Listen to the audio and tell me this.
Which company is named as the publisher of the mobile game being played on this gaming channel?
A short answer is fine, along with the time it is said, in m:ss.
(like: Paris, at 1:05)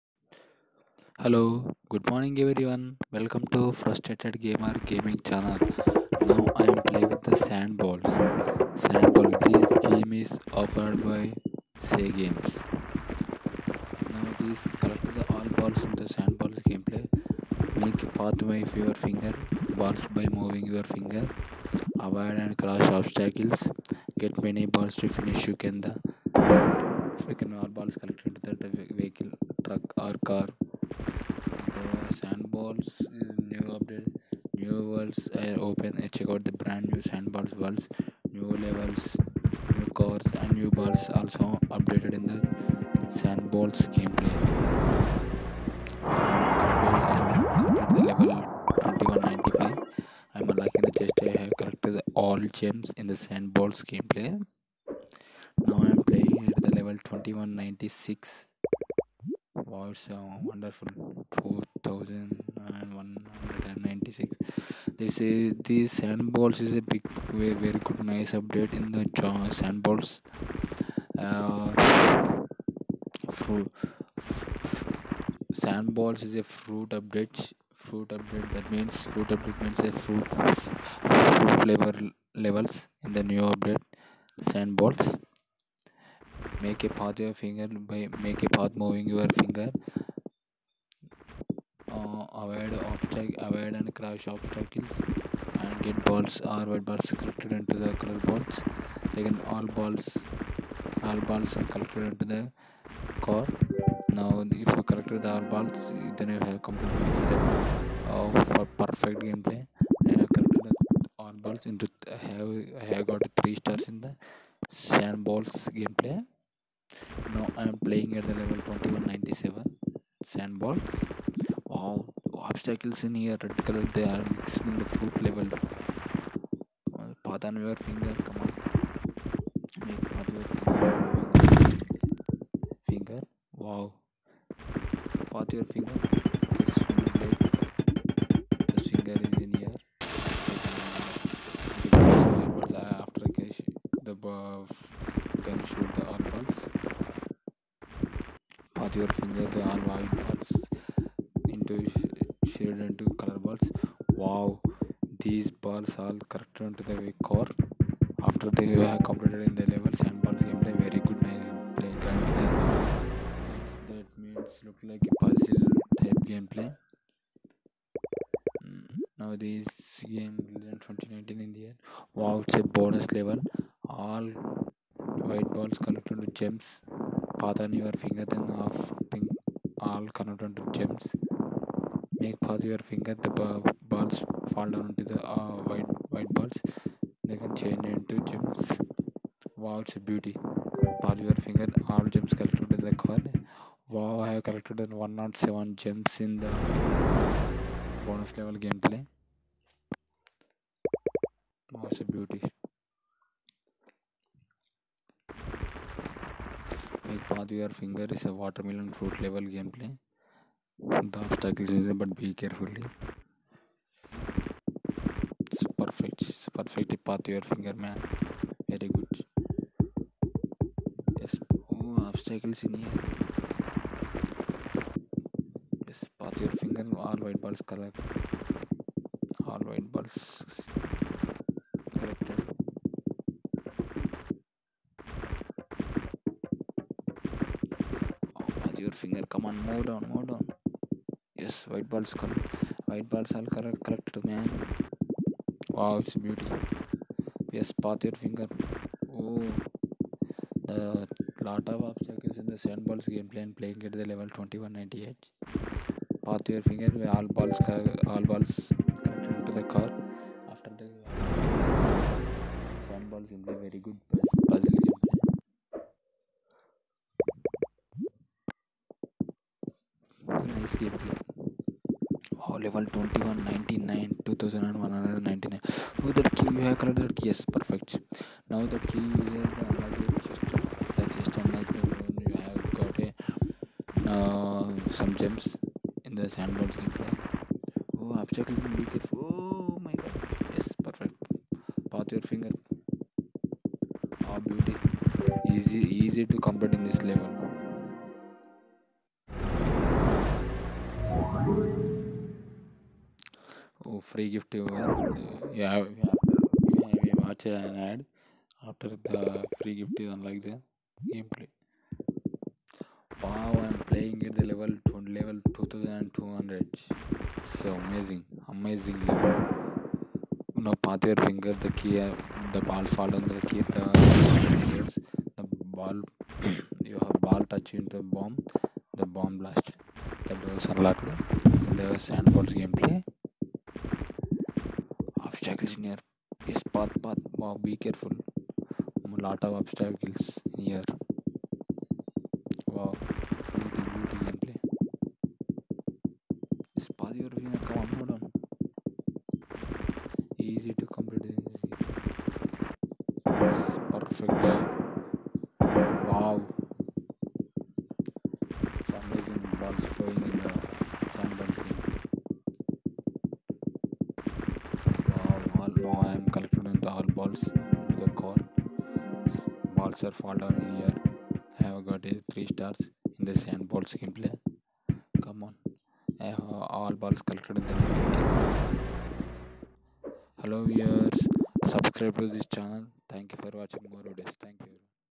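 Say Games, at 0:11.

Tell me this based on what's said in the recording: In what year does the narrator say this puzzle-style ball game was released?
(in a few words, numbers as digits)
2019.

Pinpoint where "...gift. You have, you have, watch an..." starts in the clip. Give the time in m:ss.
5:04.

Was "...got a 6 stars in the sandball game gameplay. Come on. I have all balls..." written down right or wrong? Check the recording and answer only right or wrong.
wrong.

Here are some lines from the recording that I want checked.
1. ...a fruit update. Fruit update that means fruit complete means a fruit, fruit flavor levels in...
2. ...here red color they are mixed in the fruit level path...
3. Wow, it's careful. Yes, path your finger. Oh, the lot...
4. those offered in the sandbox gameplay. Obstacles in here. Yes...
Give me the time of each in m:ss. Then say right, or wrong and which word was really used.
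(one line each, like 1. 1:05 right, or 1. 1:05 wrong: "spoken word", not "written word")
1. 1:16 wrong: "update", not "complete"
2. 2:03 right
3. 4:05 wrong: "beautiful", not "careful"
4. 5:30 wrong: "unlocked", not "offered".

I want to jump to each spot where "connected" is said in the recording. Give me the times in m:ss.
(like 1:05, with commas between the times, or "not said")
2:55, 3:00.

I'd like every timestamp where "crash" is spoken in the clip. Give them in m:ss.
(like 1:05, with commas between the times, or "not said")
0:22, 1:33.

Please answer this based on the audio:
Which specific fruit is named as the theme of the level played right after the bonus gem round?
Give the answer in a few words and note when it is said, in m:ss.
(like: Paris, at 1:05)
Watermelon, at 3:28.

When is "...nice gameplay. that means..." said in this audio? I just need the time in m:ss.
2:41.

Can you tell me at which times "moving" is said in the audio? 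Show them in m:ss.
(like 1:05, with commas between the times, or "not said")
0:20, 1:28.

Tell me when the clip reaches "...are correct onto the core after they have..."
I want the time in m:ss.
2:36.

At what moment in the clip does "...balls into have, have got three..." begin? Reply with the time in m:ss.
1:51.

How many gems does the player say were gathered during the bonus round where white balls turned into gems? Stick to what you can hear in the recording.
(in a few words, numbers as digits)
107.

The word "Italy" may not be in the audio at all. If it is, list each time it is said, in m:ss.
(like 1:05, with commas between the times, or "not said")
not said.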